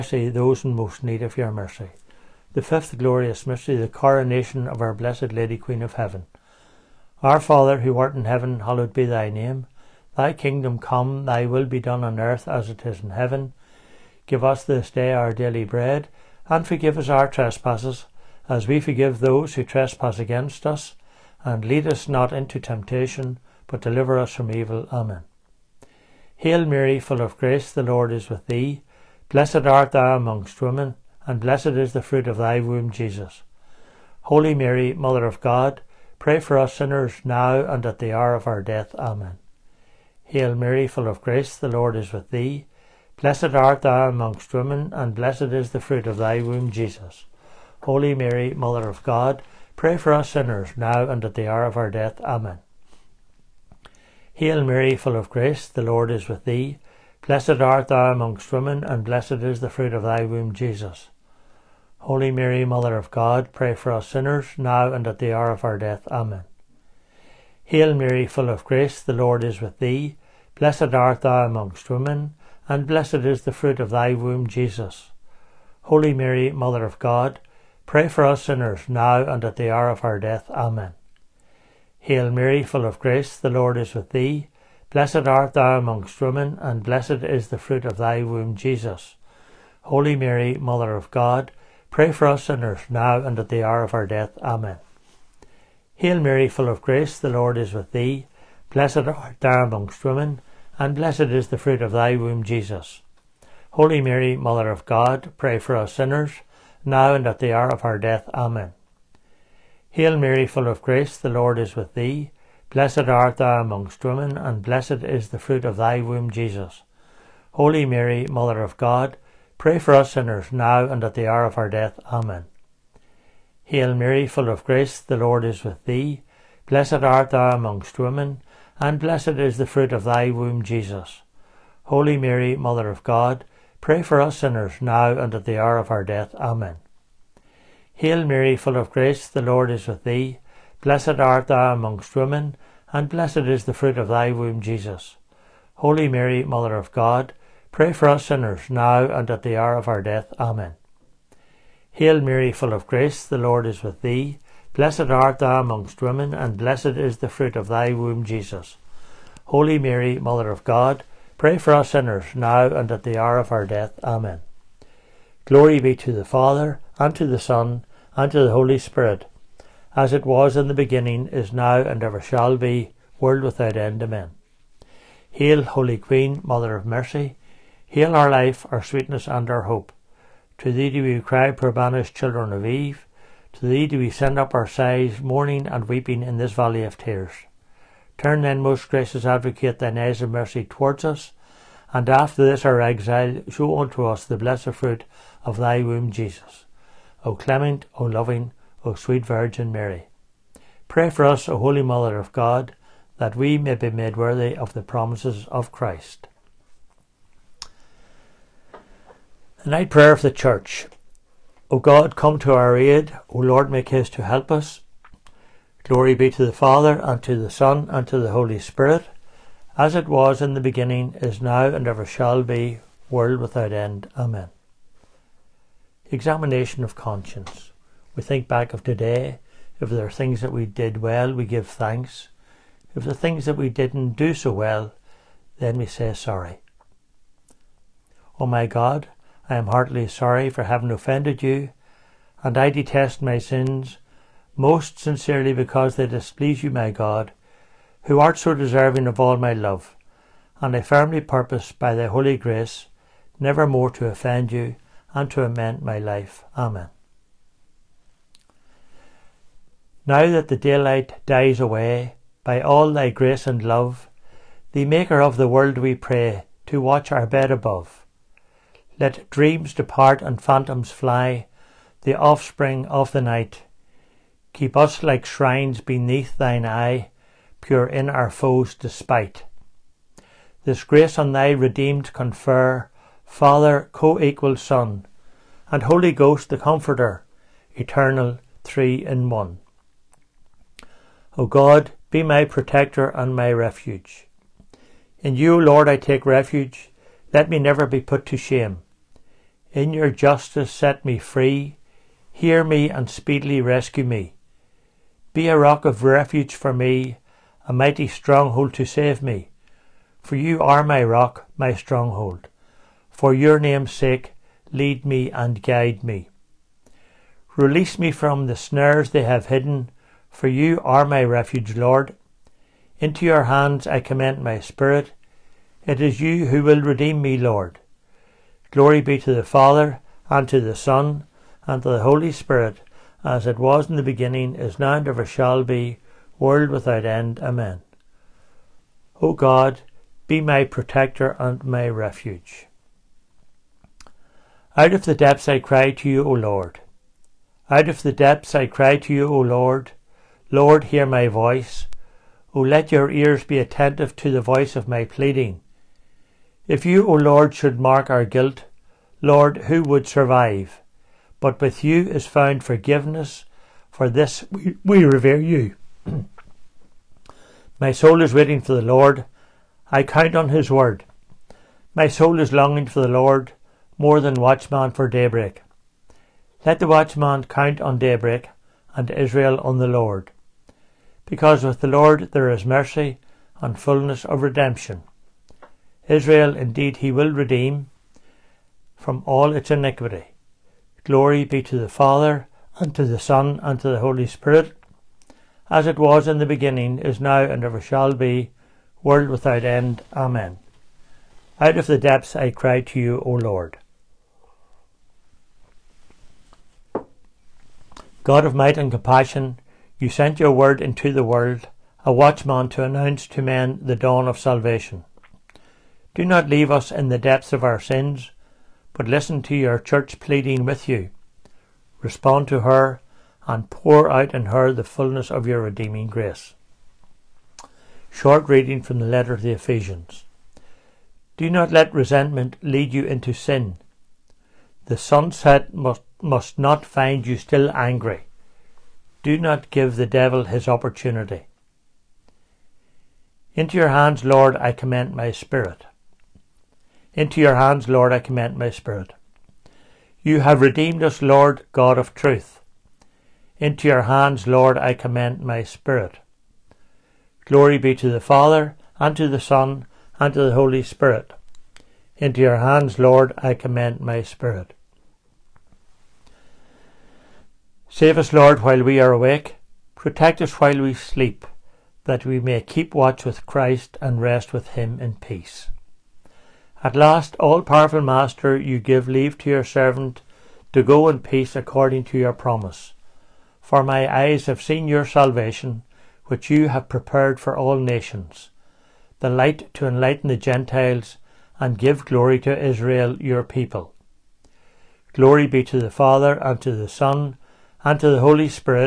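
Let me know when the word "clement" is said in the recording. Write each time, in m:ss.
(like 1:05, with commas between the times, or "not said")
3:17.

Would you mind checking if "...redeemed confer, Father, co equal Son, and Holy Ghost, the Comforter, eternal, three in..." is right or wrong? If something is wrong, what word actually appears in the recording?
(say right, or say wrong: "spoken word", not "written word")
right.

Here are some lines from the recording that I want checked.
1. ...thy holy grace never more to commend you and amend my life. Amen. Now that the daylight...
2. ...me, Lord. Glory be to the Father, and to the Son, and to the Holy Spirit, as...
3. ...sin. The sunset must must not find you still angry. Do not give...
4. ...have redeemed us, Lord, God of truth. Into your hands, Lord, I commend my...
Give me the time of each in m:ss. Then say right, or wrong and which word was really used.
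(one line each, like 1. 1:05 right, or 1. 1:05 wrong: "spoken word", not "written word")
1. 4:11 wrong: "offend", not "commend"
2. 5:27 right
3. 7:13 right
4. 7:30 right.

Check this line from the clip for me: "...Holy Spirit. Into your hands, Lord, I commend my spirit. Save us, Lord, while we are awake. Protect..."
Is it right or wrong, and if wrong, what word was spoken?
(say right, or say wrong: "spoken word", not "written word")
right.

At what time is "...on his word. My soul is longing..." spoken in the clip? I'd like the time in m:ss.
6:10.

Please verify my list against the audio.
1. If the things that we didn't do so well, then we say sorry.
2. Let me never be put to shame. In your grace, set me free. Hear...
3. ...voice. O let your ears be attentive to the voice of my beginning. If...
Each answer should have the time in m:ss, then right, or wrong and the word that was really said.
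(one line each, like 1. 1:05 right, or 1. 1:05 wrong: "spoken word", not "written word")
1. 3:52 right
2. 4:57 wrong: "justice", not "grace"
3. 5:51 wrong: "pleading", not "beginning".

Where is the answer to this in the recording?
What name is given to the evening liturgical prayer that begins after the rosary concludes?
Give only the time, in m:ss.
3:29.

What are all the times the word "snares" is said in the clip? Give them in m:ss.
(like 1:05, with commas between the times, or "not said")
5:18.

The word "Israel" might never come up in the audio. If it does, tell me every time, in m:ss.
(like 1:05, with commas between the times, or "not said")
6:19, 6:26, 8:12.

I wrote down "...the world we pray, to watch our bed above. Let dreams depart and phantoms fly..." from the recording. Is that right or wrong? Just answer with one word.
right.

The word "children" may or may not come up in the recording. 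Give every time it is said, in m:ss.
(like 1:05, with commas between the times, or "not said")
3:02.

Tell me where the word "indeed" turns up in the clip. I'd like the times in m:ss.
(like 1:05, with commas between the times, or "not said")
6:26.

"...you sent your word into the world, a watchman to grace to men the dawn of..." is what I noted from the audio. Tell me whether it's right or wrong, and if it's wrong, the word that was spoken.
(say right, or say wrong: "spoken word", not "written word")
wrong: "announce", not "grace".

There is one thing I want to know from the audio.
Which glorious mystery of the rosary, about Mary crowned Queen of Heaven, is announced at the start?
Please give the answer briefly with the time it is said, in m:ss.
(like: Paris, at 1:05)
The fifth, at 0:02.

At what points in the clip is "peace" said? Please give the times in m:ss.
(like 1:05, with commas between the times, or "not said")
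7:55, 8:01.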